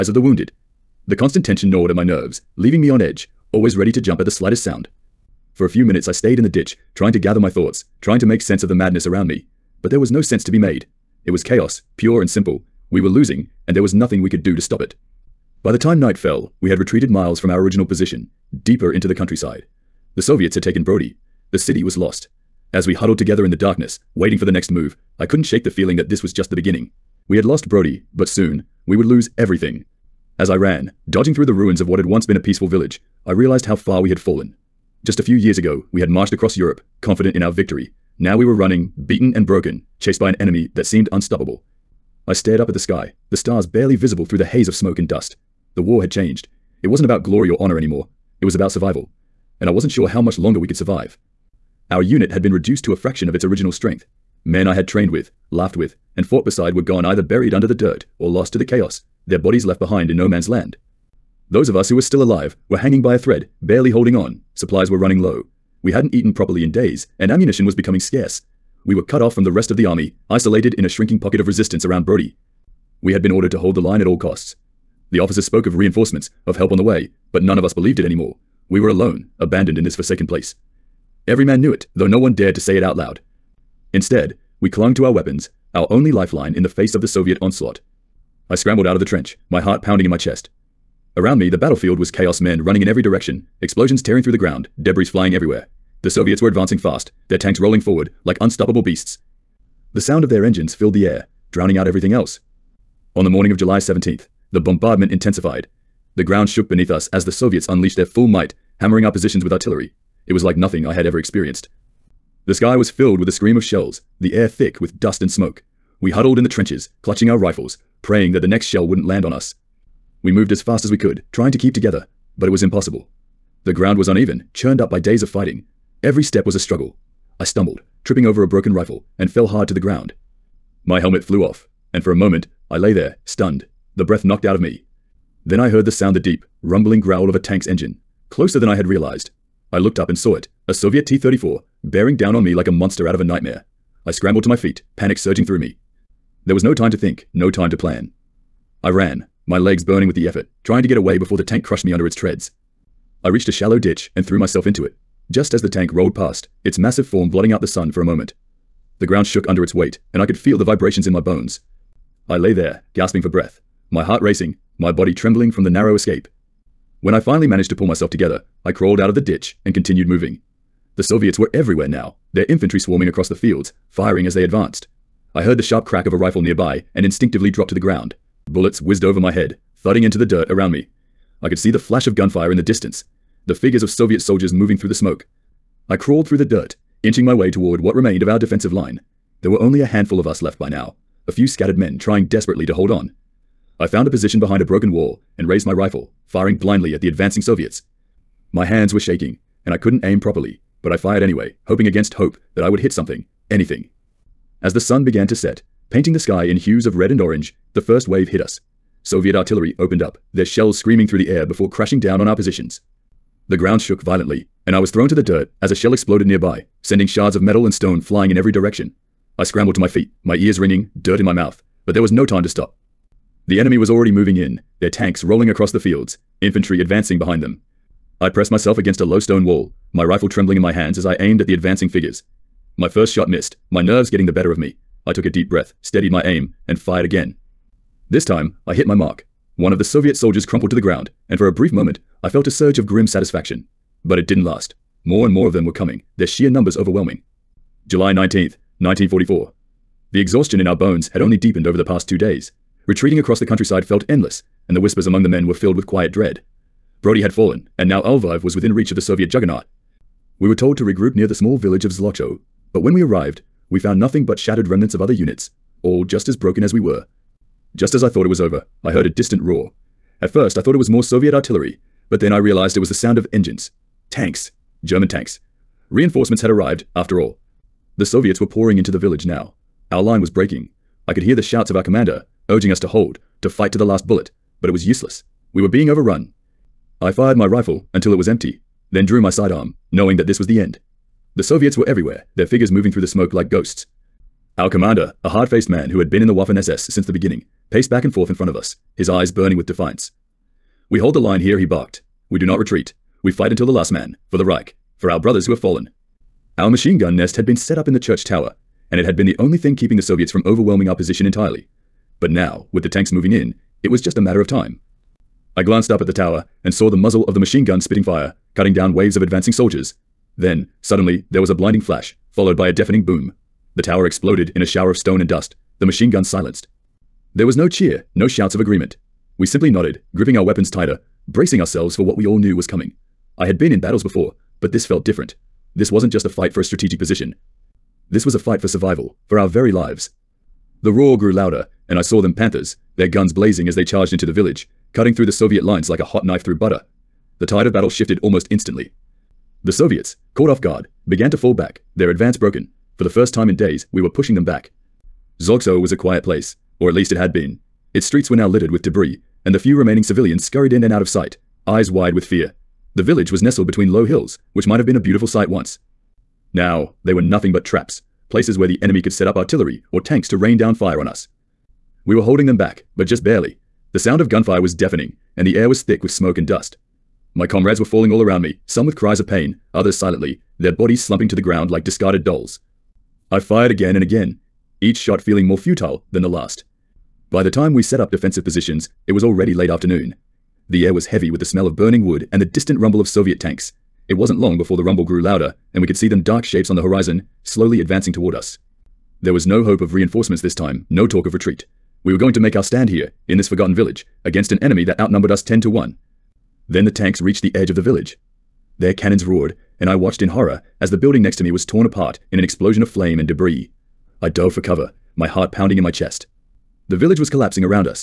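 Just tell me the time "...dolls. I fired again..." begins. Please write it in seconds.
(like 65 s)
382 s.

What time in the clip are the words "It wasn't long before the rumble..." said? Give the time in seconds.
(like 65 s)
394 s.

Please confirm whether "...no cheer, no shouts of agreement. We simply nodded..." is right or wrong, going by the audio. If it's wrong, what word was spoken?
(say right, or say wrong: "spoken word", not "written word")
right.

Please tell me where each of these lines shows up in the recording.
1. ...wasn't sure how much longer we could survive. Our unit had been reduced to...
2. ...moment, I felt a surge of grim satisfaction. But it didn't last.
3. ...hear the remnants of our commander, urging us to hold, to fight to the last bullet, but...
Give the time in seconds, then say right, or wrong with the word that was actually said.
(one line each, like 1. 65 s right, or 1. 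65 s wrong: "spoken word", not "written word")
1. 49 s right
2. 241 s right
3. 281 s wrong: "shouts", not "remnants".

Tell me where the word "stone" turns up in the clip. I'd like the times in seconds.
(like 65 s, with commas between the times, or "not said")
217 s, 229 s, 324 s.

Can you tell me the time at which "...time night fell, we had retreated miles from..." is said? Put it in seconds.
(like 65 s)
15 s.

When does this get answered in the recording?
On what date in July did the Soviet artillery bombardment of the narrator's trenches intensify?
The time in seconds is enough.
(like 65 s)
103 s.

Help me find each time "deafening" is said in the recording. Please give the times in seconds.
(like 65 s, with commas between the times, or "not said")
322 s, 374 s.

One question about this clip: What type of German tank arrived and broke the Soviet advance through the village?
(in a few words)
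Panthers.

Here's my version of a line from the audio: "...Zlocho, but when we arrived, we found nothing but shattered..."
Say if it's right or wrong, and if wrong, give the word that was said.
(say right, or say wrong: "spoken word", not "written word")
right.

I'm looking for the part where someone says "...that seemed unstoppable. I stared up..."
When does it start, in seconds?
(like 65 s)
40 s.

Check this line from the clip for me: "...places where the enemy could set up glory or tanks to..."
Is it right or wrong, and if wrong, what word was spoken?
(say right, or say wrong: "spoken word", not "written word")
wrong: "artillery", not "glory".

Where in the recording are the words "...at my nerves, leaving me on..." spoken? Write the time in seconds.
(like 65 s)
1 s.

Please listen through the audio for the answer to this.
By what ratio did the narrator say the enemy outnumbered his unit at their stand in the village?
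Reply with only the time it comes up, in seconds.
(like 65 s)
405 s.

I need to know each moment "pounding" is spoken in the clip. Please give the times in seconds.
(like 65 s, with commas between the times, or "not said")
89 s, 415 s.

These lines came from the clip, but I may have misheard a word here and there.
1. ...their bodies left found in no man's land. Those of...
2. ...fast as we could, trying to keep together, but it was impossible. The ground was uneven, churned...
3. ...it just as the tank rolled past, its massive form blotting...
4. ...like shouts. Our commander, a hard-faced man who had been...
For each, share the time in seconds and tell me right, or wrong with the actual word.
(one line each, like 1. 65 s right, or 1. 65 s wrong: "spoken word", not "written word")
1. 59 s wrong: "behind", not "found"
2. 120 s right
3. 154 s right
4. 293 s wrong: "ghosts", not "shouts".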